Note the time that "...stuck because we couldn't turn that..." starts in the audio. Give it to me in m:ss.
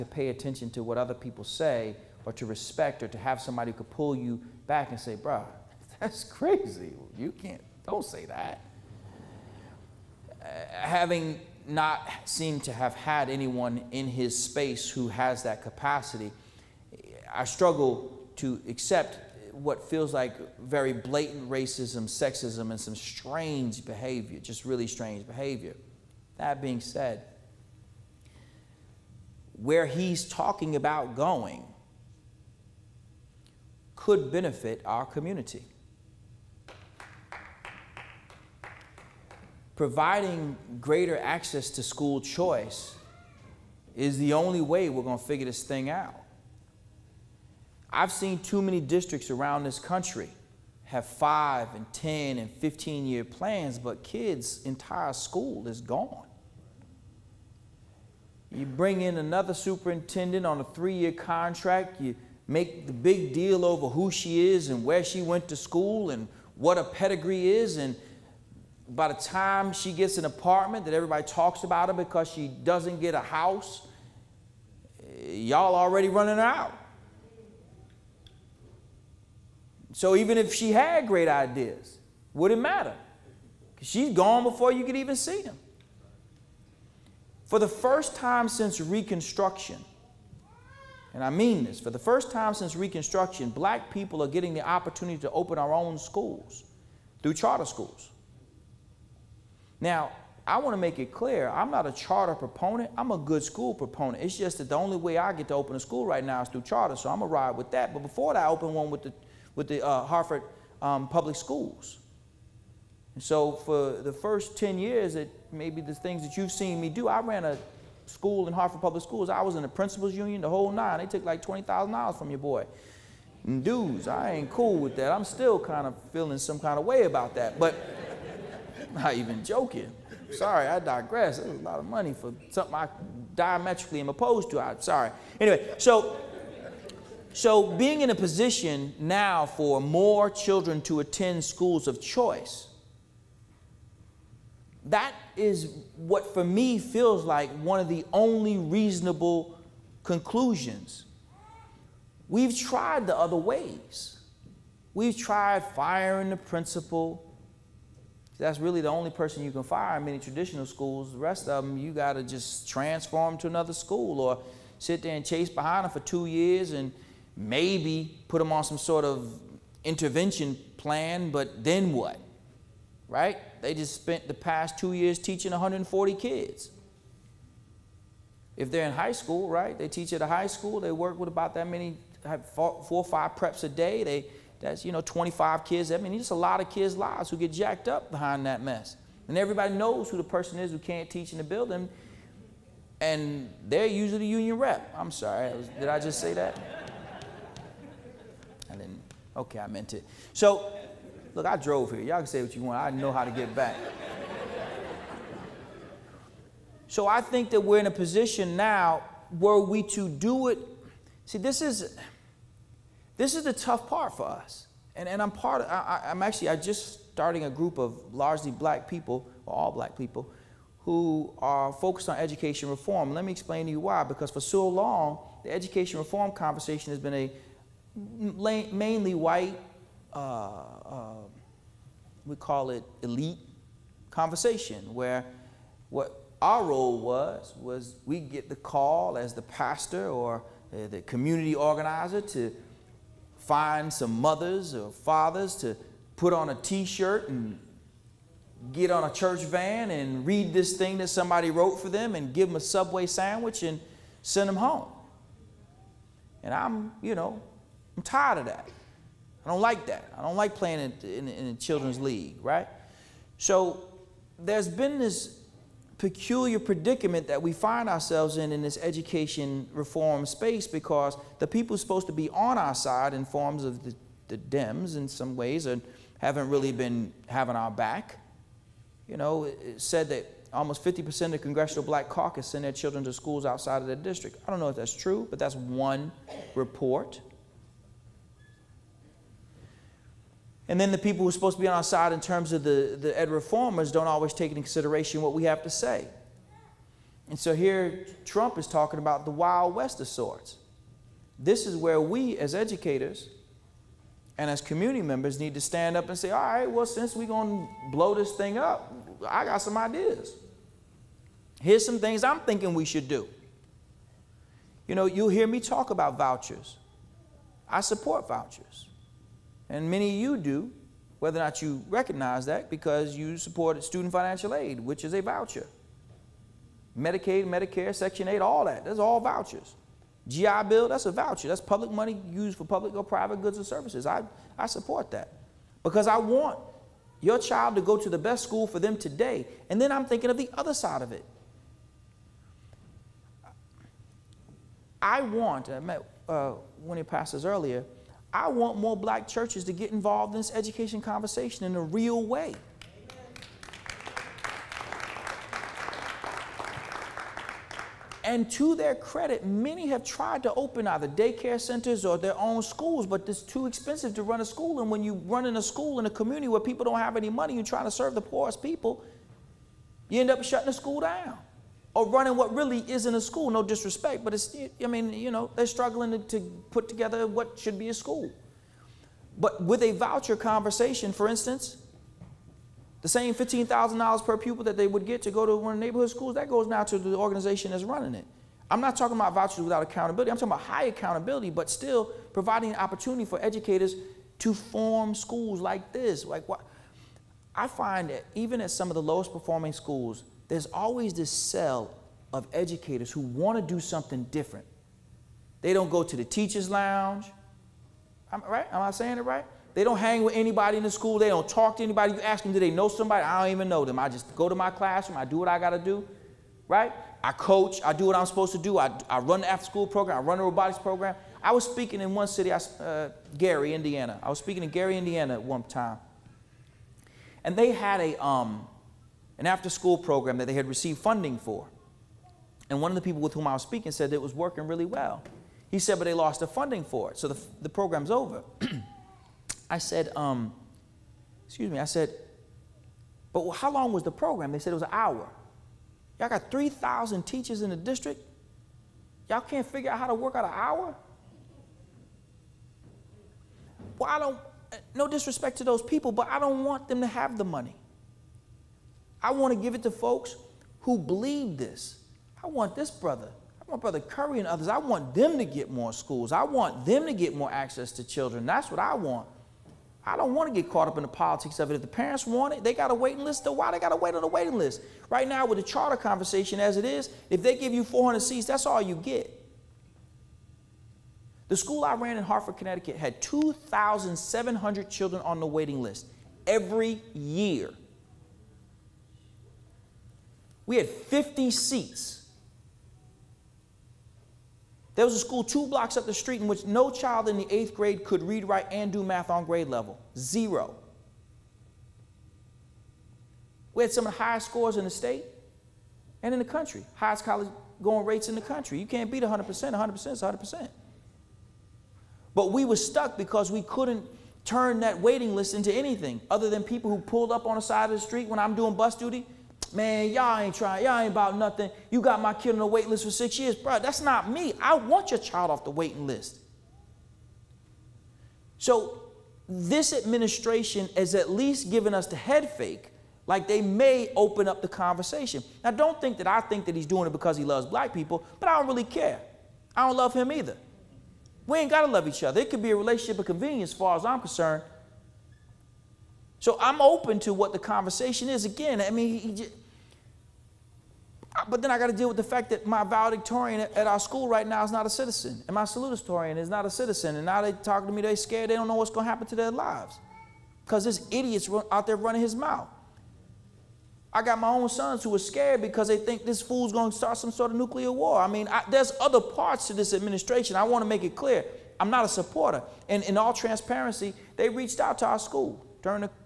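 8:32.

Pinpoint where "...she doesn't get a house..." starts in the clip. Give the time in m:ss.
1:12.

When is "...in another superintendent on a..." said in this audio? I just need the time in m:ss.
0:59.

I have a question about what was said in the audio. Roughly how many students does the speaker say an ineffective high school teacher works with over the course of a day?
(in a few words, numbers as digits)
140.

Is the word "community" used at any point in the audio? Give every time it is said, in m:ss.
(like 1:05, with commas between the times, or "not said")
0:35, 4:01, 5:04, 6:06.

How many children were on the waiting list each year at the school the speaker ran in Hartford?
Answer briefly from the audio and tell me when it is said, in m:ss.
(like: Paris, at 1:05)
2,700, at 8:03.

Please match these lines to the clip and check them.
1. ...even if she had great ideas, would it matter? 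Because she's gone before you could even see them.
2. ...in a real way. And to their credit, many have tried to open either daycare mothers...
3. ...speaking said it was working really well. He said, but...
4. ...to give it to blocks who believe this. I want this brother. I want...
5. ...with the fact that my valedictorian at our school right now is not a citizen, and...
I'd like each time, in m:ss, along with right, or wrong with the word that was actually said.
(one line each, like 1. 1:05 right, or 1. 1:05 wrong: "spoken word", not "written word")
1. 1:20 right
2. 5:51 wrong: "centers", not "mothers"
3. 7:13 right
4. 7:39 wrong: "folks", not "blocks"
5. 9:12 right.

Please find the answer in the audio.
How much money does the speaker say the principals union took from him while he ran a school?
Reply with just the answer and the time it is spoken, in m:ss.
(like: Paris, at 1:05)
$20,000, at 2:01.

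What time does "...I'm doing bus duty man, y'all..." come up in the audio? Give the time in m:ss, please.
8:38.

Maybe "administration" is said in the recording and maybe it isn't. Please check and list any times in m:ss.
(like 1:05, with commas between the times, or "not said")
8:49, 9:29.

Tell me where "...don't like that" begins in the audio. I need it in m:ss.
4:19.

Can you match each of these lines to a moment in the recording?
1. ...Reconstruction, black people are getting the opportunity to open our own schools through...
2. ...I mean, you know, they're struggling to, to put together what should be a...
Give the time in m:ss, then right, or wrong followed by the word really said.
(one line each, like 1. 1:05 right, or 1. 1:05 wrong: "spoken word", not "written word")
1. 1:32 right
2. 6:14 right.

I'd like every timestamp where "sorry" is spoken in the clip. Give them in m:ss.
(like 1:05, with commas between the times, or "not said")
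2:10, 2:14, 3:15.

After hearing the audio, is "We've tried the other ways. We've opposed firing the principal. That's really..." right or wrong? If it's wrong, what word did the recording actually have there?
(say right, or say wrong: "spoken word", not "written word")
wrong: "tried", not "opposed".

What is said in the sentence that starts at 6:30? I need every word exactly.
I'm talking about high accountability, but still providing an opportunity for educators to form schools like this.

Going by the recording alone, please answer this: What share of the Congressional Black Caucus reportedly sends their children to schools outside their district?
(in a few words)
almost 50%.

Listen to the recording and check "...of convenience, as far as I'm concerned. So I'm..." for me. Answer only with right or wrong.
right.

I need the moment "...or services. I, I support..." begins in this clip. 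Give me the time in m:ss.
5:33.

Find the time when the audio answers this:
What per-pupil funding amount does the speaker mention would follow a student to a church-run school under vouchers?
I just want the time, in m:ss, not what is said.
6:23.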